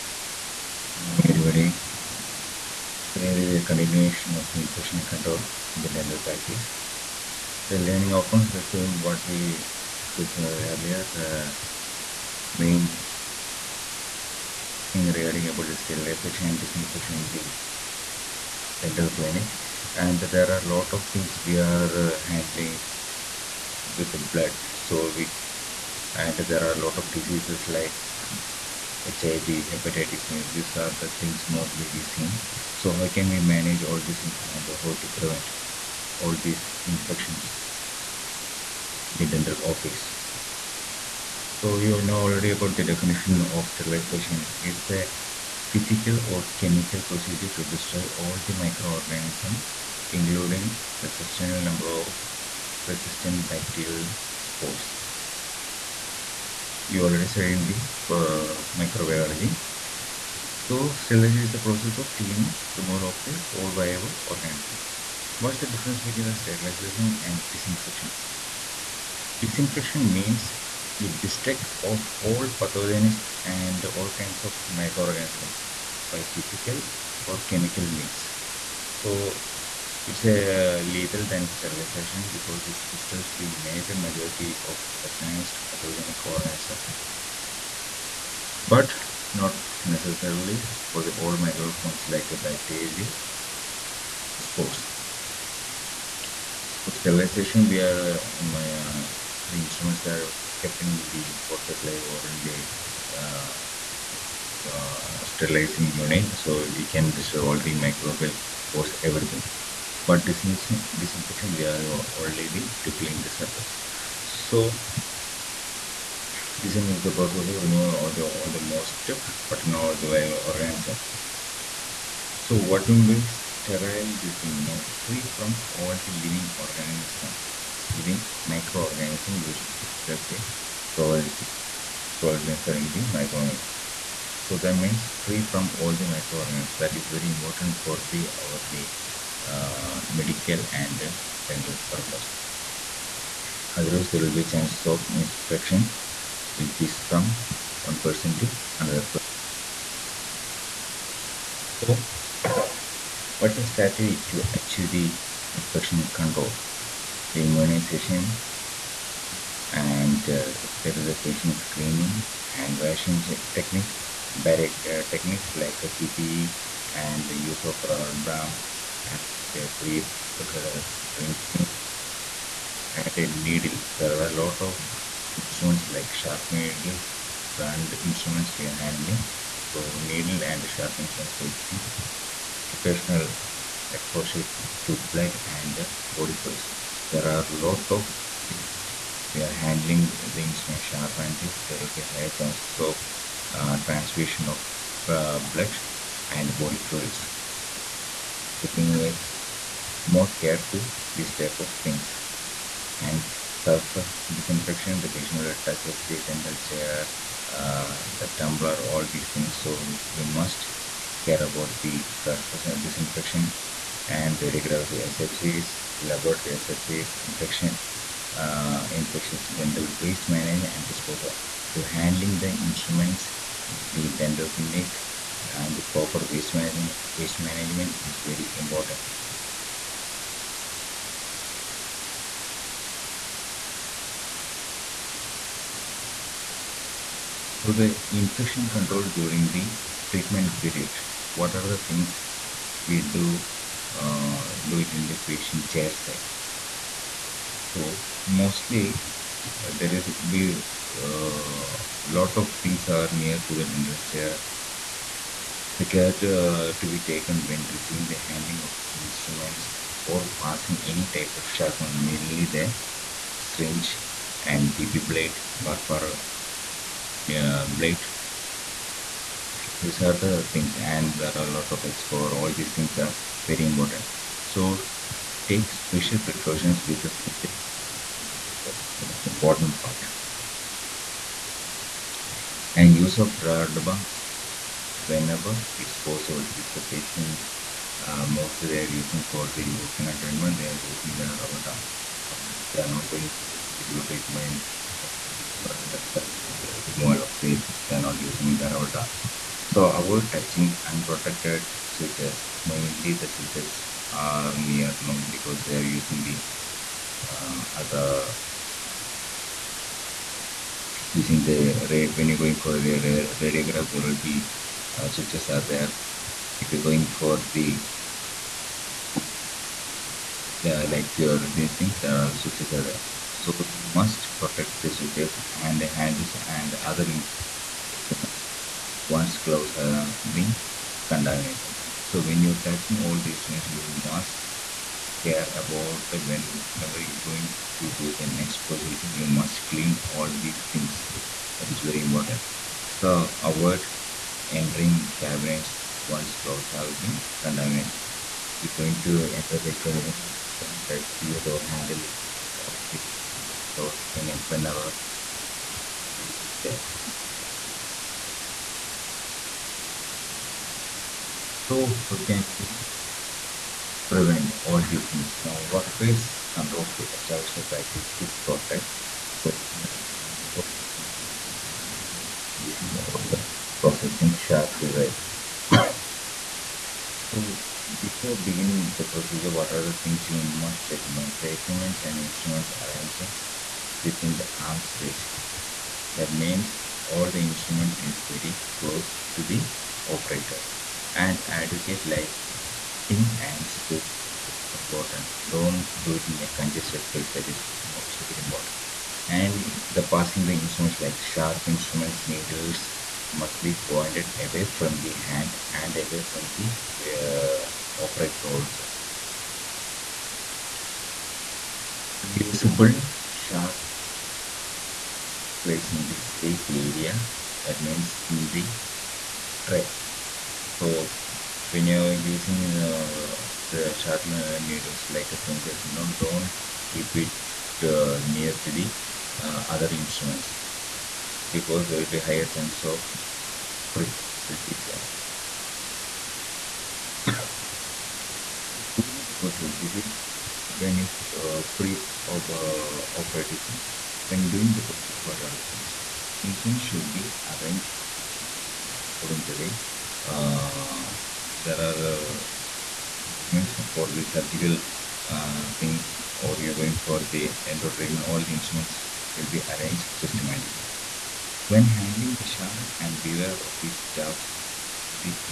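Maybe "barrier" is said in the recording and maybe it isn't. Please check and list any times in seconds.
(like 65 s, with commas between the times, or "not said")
164 s.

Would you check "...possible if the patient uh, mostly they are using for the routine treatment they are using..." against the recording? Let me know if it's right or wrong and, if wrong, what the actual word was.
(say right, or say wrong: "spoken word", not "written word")
right.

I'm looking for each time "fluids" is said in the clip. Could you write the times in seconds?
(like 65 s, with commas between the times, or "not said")
186 s, 196 s.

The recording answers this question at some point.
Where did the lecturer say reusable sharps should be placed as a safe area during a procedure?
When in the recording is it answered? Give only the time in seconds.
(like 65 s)
418 s.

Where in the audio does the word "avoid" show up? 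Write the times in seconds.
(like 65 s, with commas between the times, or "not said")
300 s, 343 s.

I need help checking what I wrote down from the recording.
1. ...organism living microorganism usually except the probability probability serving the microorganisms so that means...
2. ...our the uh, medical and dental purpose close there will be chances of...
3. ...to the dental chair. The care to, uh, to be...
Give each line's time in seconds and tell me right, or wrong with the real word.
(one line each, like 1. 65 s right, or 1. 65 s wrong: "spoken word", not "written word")
1. 126 s right
2. 138 s wrong: "otherwise", not "close"
3. 253 s right.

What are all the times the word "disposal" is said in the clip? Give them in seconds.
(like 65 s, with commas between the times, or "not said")
220 s.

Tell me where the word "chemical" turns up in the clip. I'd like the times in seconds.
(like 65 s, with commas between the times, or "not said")
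46 s, 77 s.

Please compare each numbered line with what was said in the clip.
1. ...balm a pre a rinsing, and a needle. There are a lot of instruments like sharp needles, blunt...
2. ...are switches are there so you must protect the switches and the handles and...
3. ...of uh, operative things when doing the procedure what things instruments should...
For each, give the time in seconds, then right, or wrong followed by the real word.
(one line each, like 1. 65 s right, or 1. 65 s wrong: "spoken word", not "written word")
1. 168 s right
2. 322 s right
3. 442 s right.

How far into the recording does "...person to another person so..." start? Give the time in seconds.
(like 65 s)
148 s.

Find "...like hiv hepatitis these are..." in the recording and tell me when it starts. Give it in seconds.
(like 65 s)
27 s.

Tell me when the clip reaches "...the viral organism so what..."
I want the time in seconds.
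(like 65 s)
120 s.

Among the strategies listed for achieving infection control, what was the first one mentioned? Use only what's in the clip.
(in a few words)
immunization.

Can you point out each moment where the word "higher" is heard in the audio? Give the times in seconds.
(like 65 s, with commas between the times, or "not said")
192 s, 432 s.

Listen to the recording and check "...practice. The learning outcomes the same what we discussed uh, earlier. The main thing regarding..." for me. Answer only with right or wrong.
right.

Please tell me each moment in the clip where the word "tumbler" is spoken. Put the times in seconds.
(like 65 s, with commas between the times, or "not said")
208 s.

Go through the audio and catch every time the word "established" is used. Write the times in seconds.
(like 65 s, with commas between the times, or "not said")
367 s.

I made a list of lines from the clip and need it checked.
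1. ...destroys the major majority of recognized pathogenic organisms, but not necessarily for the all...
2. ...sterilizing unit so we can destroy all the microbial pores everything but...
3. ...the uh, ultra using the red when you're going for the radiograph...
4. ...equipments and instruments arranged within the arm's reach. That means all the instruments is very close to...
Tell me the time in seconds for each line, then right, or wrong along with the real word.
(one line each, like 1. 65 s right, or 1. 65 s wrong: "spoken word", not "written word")
1. 82 s right
2. 105 s right
3. 306 s right
4. 381 s right.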